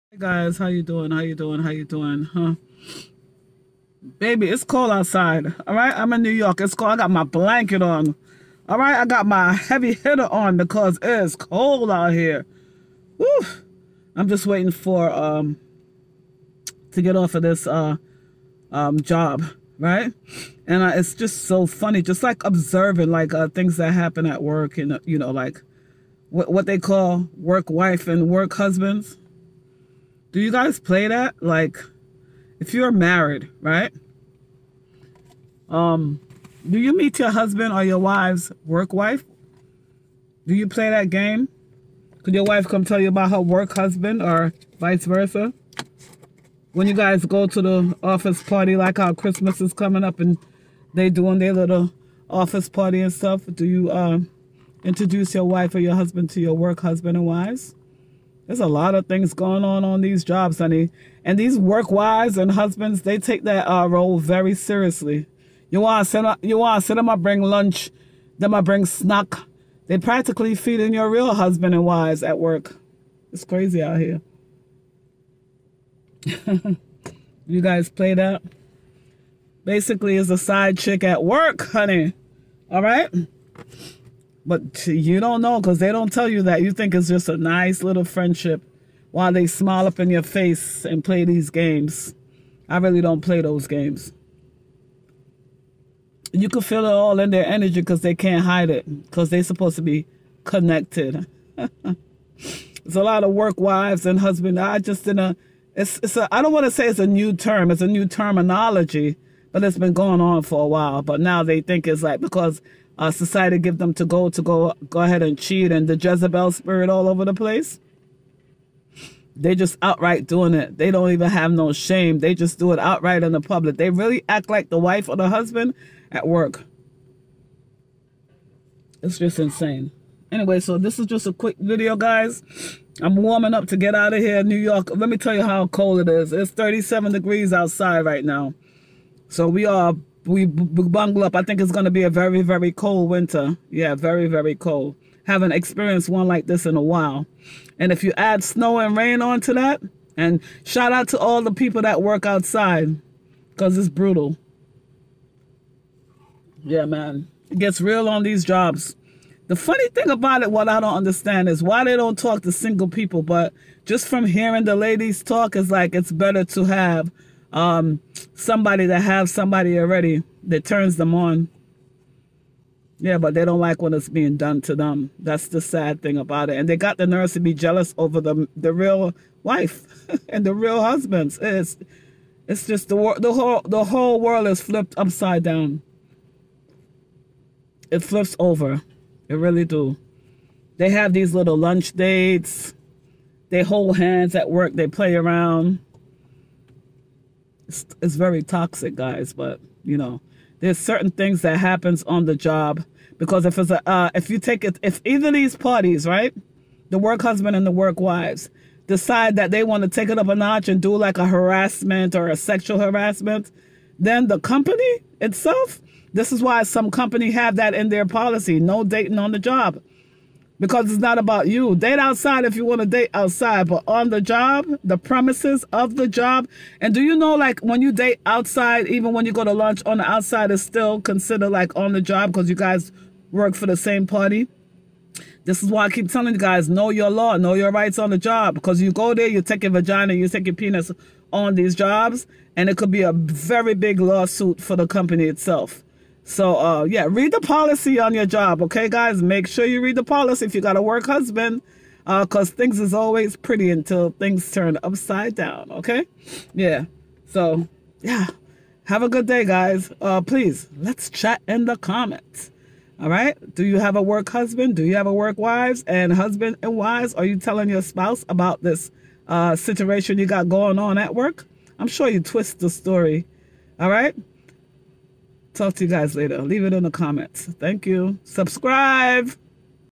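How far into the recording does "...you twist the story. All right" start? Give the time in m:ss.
4:32.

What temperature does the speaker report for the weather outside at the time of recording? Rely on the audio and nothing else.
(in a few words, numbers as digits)
37 degrees.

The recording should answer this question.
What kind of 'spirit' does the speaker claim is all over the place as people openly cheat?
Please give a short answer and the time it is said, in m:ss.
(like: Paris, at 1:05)
Jezebel spirit, at 1:55.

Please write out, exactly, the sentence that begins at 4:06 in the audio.
So uh, yeah, read the policy on your job, okay, guys.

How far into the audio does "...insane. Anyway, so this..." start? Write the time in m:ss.
2:09.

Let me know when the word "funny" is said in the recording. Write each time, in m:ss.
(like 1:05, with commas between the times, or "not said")
0:21, 2:39.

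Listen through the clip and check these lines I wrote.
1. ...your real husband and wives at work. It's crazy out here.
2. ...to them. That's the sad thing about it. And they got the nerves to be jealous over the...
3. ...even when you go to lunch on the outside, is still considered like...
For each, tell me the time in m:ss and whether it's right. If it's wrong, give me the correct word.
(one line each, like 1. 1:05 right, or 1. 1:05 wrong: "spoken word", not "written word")
1. 1:10 right
2. 2:54 right
3. 3:48 right.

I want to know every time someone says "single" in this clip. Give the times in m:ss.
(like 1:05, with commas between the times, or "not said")
2:42.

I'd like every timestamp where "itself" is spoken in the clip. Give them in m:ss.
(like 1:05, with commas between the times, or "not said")
3:35, 4:05.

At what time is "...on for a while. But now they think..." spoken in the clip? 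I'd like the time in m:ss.
1:50.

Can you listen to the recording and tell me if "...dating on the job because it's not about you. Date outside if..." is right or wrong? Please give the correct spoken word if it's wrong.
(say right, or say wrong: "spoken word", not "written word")
right.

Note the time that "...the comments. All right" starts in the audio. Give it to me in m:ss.
4:21.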